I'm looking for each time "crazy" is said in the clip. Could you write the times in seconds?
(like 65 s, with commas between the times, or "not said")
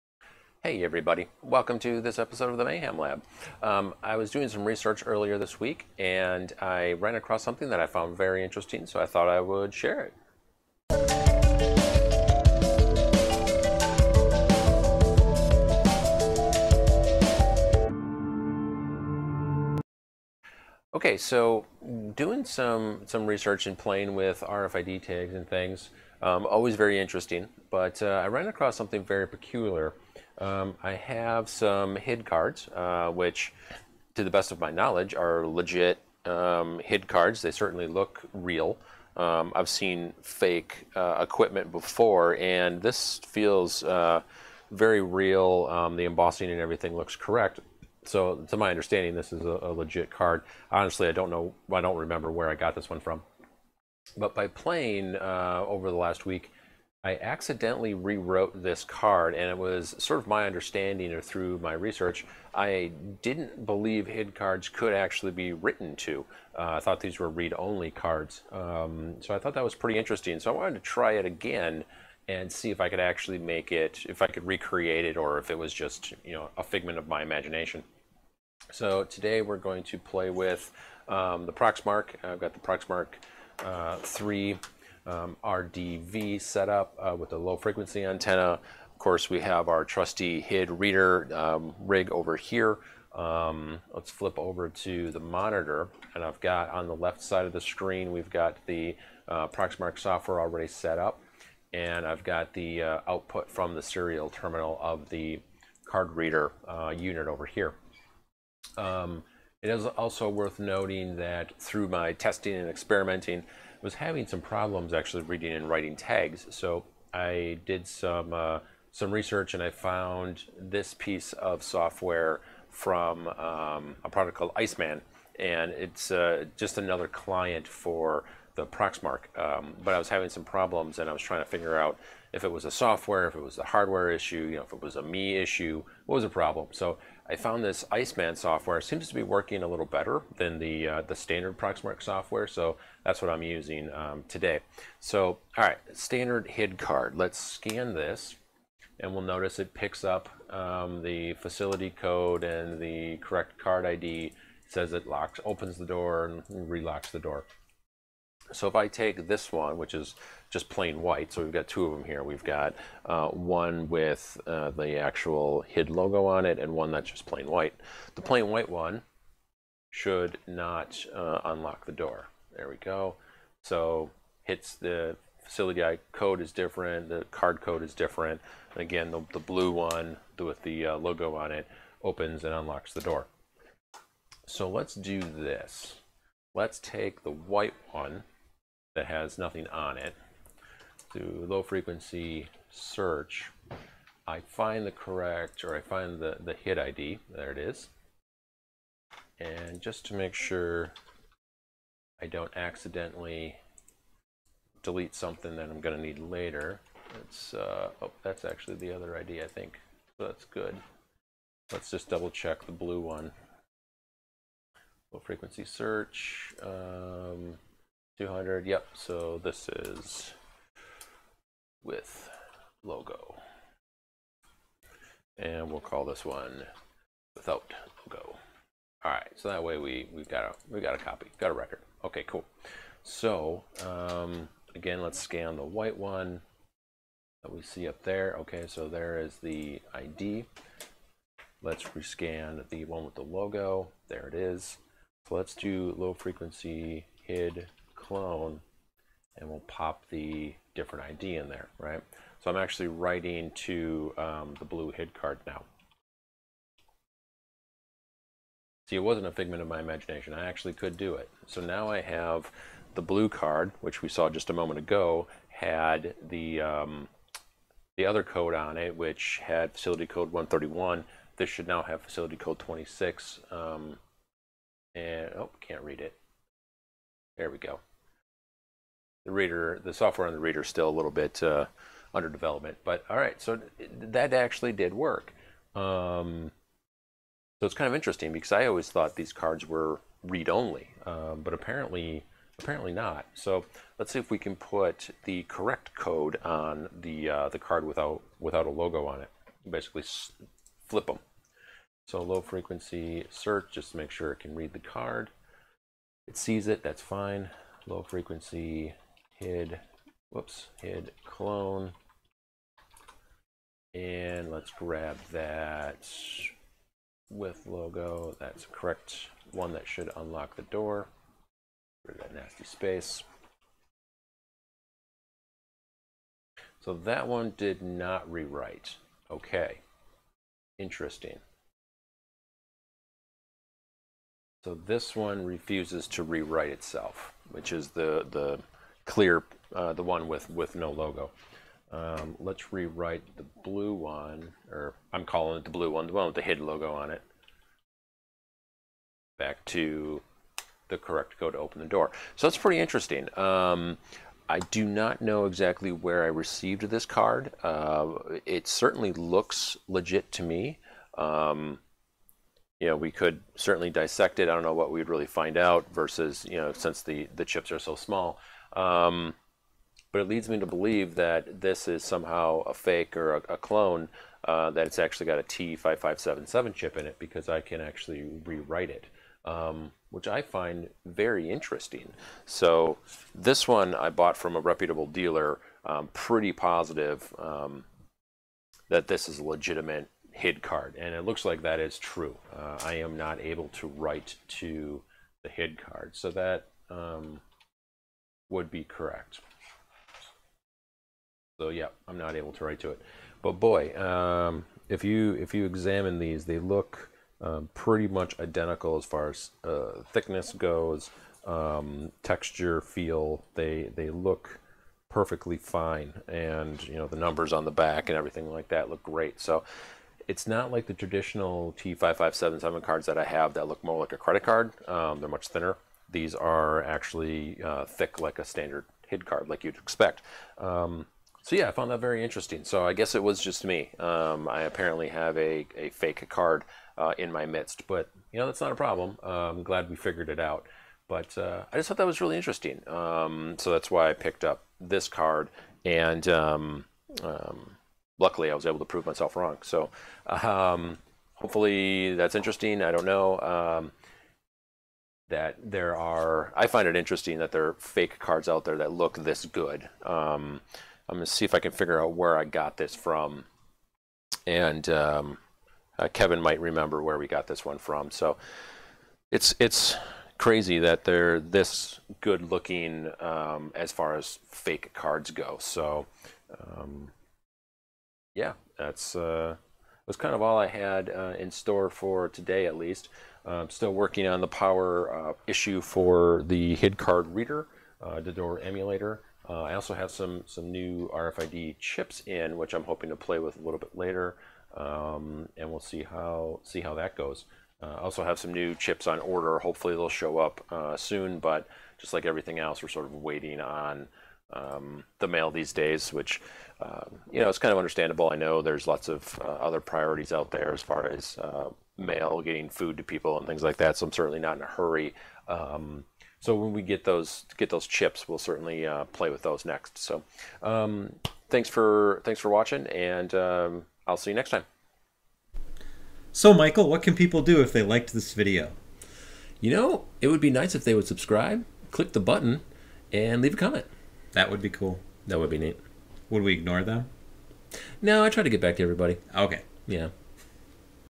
470 s.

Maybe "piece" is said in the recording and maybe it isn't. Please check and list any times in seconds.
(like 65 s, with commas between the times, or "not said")
120 s.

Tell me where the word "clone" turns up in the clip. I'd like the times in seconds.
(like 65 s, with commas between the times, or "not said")
248 s, 311 s, 373 s.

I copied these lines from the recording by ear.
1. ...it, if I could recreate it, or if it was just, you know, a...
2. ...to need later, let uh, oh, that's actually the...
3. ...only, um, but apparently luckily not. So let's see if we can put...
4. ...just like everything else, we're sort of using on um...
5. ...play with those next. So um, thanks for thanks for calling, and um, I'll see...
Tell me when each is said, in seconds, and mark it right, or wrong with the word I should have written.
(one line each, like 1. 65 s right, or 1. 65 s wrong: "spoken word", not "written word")
1. 73 s right
2. 205 s right
3. 290 s wrong: "apparently", not "luckily"
4. 501 s wrong: "waiting", not "using"
5. 519 s wrong: "watching", not "calling".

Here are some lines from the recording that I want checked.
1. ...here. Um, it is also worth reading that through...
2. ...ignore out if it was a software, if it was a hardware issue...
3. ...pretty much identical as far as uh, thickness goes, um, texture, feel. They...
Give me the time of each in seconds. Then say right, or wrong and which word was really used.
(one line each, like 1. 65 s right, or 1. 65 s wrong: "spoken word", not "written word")
1. 107 s wrong: "noting", not "reading"
2. 131 s wrong: "figure", not "ignore"
3. 407 s right.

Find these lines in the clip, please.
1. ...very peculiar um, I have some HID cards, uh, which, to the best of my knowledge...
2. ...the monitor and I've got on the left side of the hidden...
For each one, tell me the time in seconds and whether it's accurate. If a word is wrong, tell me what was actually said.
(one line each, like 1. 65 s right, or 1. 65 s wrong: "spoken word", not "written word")
1. 29 s right
2. 95 s wrong: "screen", not "hidden".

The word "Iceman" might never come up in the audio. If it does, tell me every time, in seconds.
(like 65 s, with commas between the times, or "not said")
124 s, 137 s.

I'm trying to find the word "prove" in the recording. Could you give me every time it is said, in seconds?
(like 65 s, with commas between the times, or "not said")
448 s.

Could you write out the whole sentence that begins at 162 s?
We've got uh, one with uh, the actual HID logo on it and one that's just plain white.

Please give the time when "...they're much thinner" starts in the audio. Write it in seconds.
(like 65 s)
425 s.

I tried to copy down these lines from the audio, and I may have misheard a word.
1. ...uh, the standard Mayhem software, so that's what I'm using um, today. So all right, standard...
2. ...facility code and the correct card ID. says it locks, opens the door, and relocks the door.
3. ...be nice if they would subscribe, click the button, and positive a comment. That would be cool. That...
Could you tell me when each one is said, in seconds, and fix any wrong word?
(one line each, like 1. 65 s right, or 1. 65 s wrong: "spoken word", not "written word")
1. 140 s wrong: "Proxmark", not "Mayhem"
2. 151 s right
3. 530 s wrong: "leave", not "positive".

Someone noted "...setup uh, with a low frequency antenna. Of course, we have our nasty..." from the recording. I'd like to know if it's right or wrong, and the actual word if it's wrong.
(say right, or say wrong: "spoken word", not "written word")
wrong: "trusty", not "nasty".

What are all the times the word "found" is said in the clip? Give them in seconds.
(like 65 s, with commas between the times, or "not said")
7 s, 119 s, 137 s, 431 s.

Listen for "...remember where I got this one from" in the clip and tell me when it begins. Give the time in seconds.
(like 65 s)
51 s.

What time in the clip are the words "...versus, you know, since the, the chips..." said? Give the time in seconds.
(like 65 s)
365 s.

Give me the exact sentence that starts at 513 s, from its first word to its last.
So I'm certainly not in a hurry.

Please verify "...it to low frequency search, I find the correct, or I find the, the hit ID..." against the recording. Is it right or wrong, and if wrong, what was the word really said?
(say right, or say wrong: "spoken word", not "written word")
right.